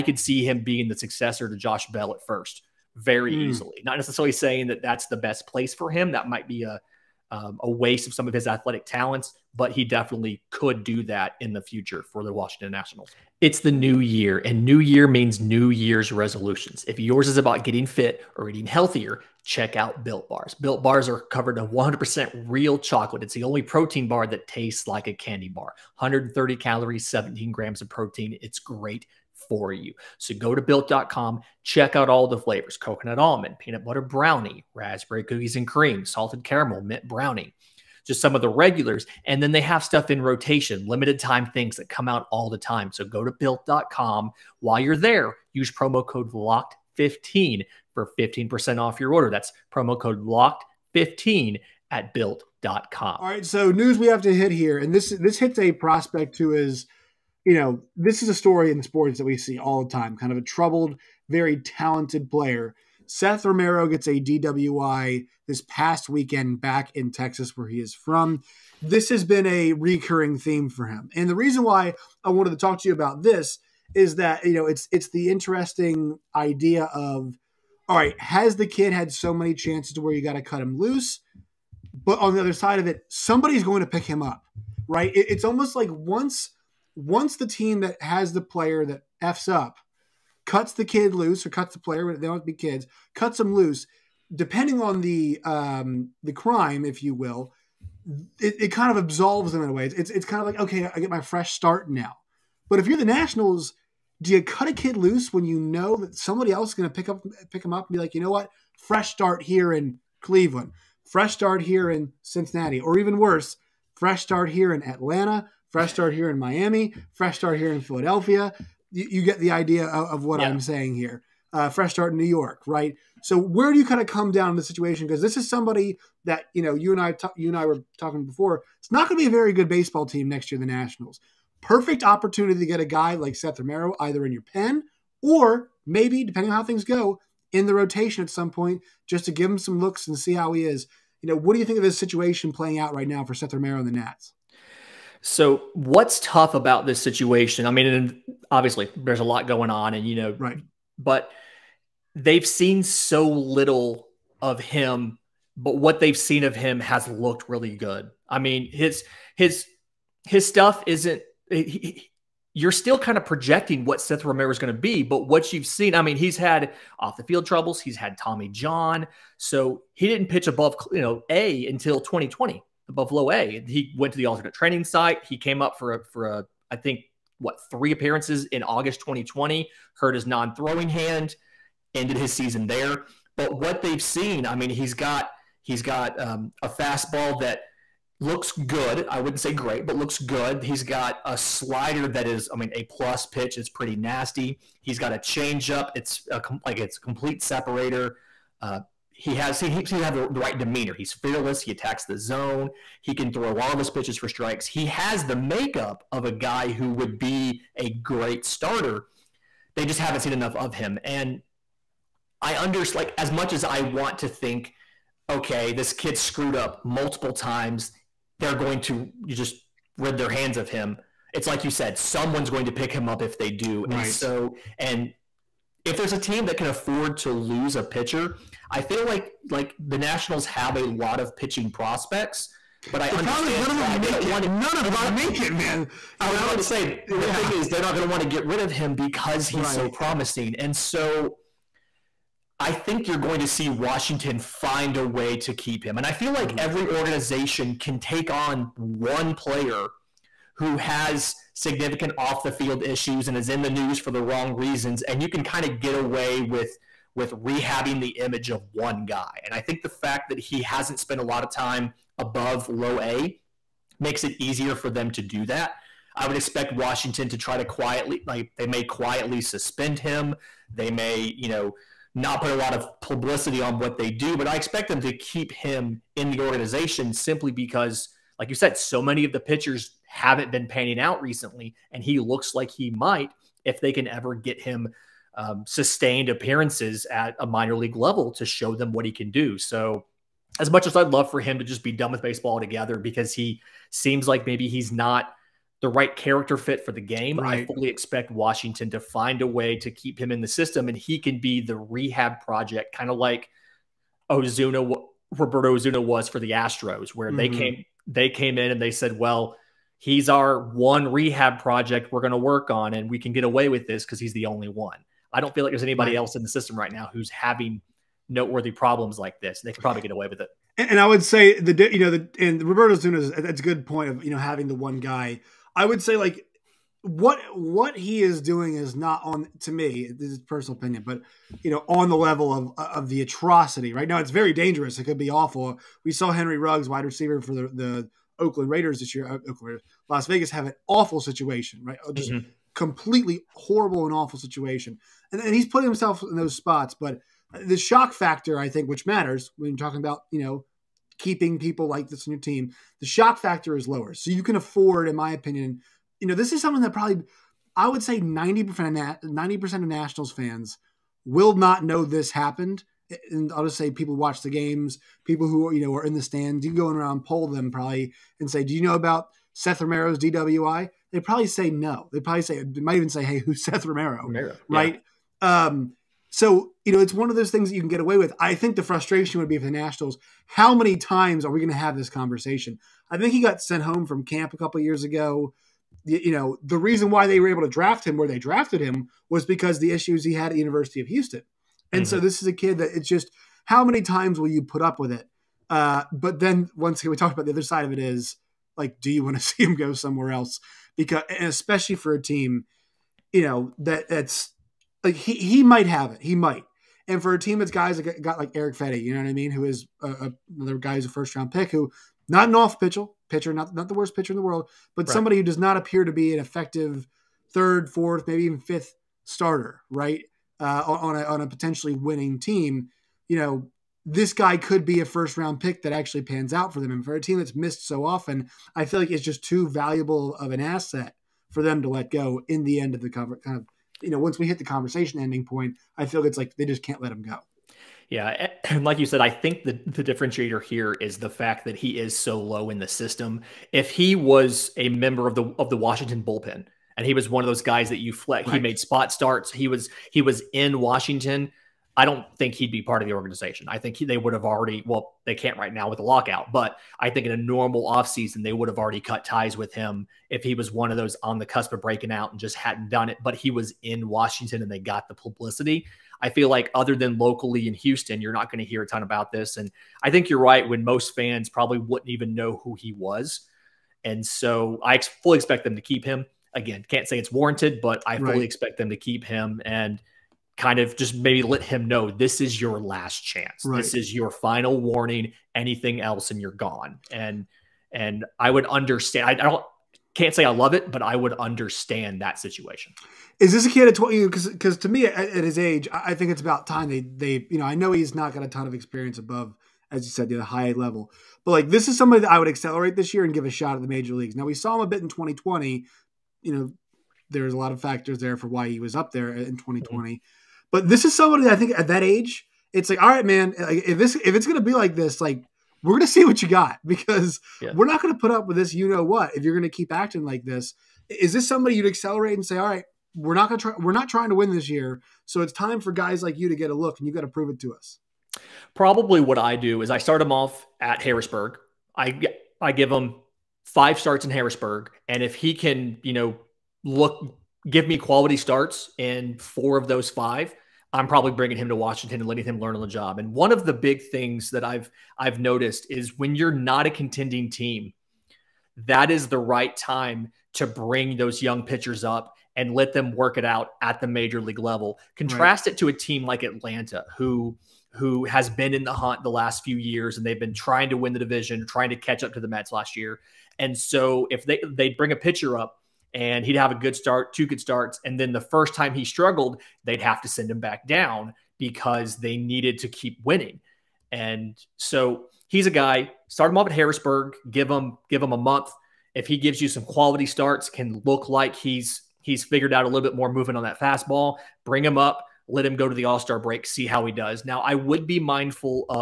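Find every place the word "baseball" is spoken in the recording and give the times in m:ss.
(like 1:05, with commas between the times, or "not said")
2:09, 4:52.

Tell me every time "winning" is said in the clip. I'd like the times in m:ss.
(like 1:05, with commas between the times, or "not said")
7:01, 9:33.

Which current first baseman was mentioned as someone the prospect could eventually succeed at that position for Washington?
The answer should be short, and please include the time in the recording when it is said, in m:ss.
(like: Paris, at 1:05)
Josh Bell, at 0:01.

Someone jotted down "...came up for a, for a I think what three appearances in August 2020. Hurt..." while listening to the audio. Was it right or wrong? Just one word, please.
right.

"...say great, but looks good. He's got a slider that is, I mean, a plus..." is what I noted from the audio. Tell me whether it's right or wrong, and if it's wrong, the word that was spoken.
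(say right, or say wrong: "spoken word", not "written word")
right.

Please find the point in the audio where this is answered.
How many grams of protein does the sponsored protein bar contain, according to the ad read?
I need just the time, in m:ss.
0:27.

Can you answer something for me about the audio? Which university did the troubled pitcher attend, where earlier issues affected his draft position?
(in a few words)
University of Houston.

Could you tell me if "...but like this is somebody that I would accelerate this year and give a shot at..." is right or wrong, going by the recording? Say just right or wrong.
right.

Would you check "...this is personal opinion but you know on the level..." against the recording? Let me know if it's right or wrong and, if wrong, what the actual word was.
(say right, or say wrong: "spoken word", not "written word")
right.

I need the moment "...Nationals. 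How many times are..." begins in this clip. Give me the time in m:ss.
6:19.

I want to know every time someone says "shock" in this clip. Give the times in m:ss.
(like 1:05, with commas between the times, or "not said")
5:47, 5:53.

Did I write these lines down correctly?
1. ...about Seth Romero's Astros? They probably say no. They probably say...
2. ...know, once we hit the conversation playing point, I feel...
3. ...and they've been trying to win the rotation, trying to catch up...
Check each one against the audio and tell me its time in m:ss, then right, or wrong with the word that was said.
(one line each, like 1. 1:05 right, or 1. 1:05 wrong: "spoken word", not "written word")
1. 6:08 wrong: "DWI", not "Astros"
2. 7:14 wrong: "ending", not "playing"
3. 9:20 wrong: "division", not "rotation".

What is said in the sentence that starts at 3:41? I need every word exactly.
It's like you said, someone's going to pick him up if they do.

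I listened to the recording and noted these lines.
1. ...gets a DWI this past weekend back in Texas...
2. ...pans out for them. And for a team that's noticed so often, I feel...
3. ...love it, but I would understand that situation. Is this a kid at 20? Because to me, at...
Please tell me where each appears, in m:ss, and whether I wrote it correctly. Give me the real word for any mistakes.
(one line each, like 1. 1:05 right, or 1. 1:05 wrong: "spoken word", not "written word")
1. 1:03 right
2. 7:06 wrong: "missed", not "noticed"
3. 8:10 right.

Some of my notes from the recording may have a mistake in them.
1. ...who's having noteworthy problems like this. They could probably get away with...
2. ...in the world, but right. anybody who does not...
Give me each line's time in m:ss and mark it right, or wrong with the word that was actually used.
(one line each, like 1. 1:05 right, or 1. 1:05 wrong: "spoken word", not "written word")
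1. 5:17 right
2. 6:54 wrong: "somebody", not "anybody".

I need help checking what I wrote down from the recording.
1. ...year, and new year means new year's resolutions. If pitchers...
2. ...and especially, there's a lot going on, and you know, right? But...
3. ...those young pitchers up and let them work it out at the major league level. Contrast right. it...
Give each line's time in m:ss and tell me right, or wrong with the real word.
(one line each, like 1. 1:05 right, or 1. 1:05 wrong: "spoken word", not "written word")
1. 0:14 wrong: "yours", not "pitchers"
2. 2:27 wrong: "obviously", not "especially"
3. 9:11 right.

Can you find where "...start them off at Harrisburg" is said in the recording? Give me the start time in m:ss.
8:49.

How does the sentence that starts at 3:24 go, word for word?
He has the makeup of a guy who would be a great starter.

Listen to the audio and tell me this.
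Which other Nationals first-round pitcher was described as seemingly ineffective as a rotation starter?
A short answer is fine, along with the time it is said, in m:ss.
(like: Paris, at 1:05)
Erick Fedde, at 6:48.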